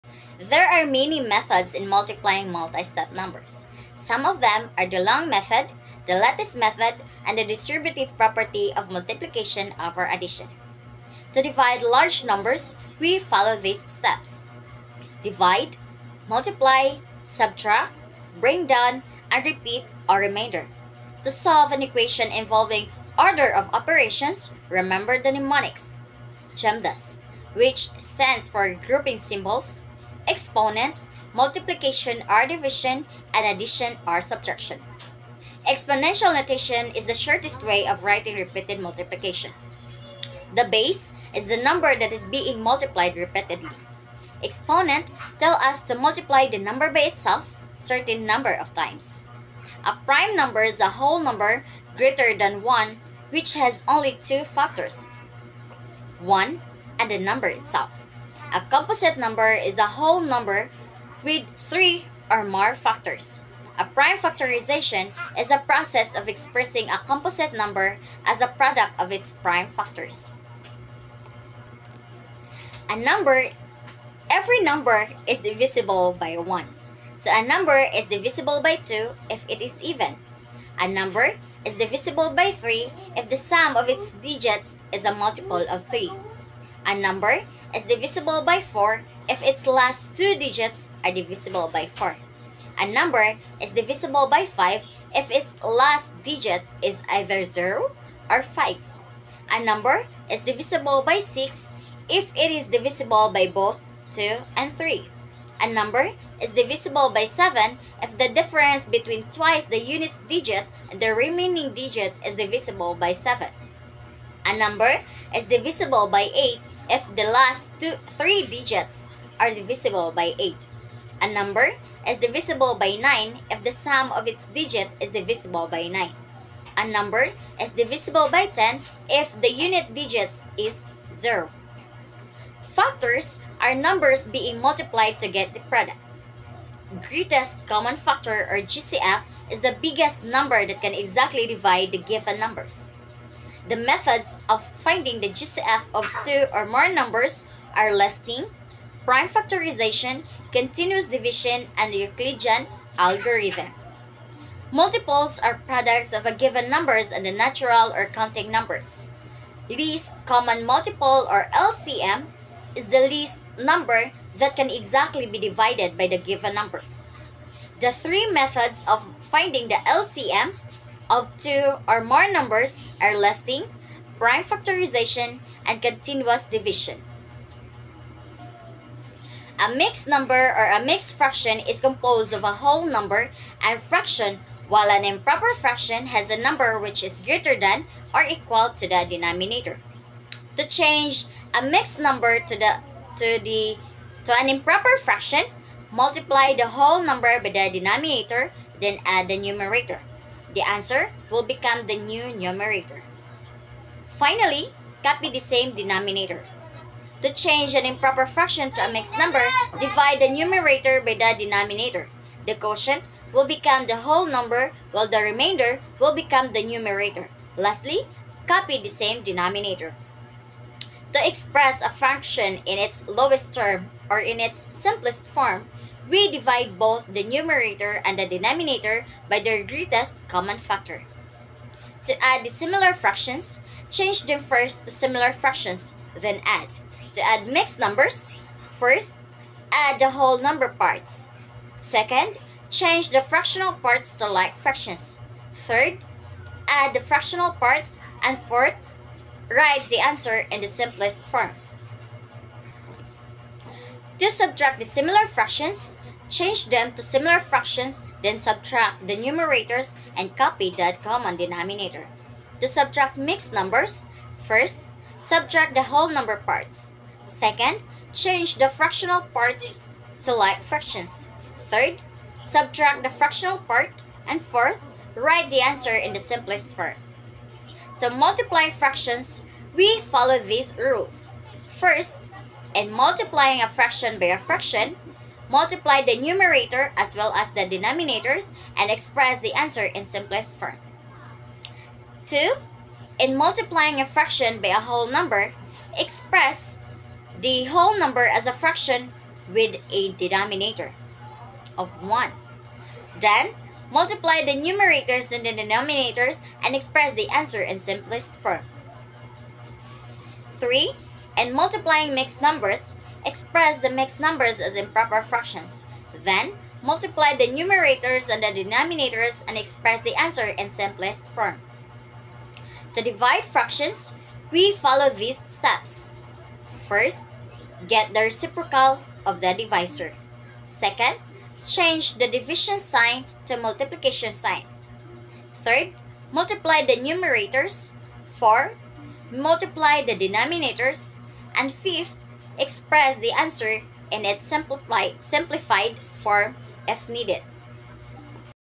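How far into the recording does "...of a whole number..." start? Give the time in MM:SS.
03:02.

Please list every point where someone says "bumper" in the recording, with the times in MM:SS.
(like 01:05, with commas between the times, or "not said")
not said.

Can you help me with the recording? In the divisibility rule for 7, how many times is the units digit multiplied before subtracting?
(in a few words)
twice.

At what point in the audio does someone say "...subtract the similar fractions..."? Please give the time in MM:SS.
04:14.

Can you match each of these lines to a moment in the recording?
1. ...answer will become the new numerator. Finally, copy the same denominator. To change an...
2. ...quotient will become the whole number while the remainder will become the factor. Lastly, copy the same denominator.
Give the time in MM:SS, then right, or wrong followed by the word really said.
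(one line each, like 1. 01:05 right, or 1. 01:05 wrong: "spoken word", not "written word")
1. 03:20 right
2. 03:32 wrong: "numerator", not "factor".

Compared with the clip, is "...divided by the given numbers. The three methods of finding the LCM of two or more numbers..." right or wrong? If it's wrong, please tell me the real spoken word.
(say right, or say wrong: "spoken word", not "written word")
right.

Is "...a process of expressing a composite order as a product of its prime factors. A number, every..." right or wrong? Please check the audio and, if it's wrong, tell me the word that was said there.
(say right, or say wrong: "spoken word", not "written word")
wrong: "number", not "order".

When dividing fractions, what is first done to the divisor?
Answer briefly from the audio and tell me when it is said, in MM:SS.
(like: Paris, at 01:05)
get the reciprocal, at 05:27.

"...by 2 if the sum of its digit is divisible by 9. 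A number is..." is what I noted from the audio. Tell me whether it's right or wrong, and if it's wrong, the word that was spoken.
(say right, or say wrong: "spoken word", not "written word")
wrong: "9", not "2".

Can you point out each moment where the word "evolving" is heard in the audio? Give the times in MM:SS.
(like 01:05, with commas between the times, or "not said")
not said.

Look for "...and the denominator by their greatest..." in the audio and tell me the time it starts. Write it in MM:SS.
03:48.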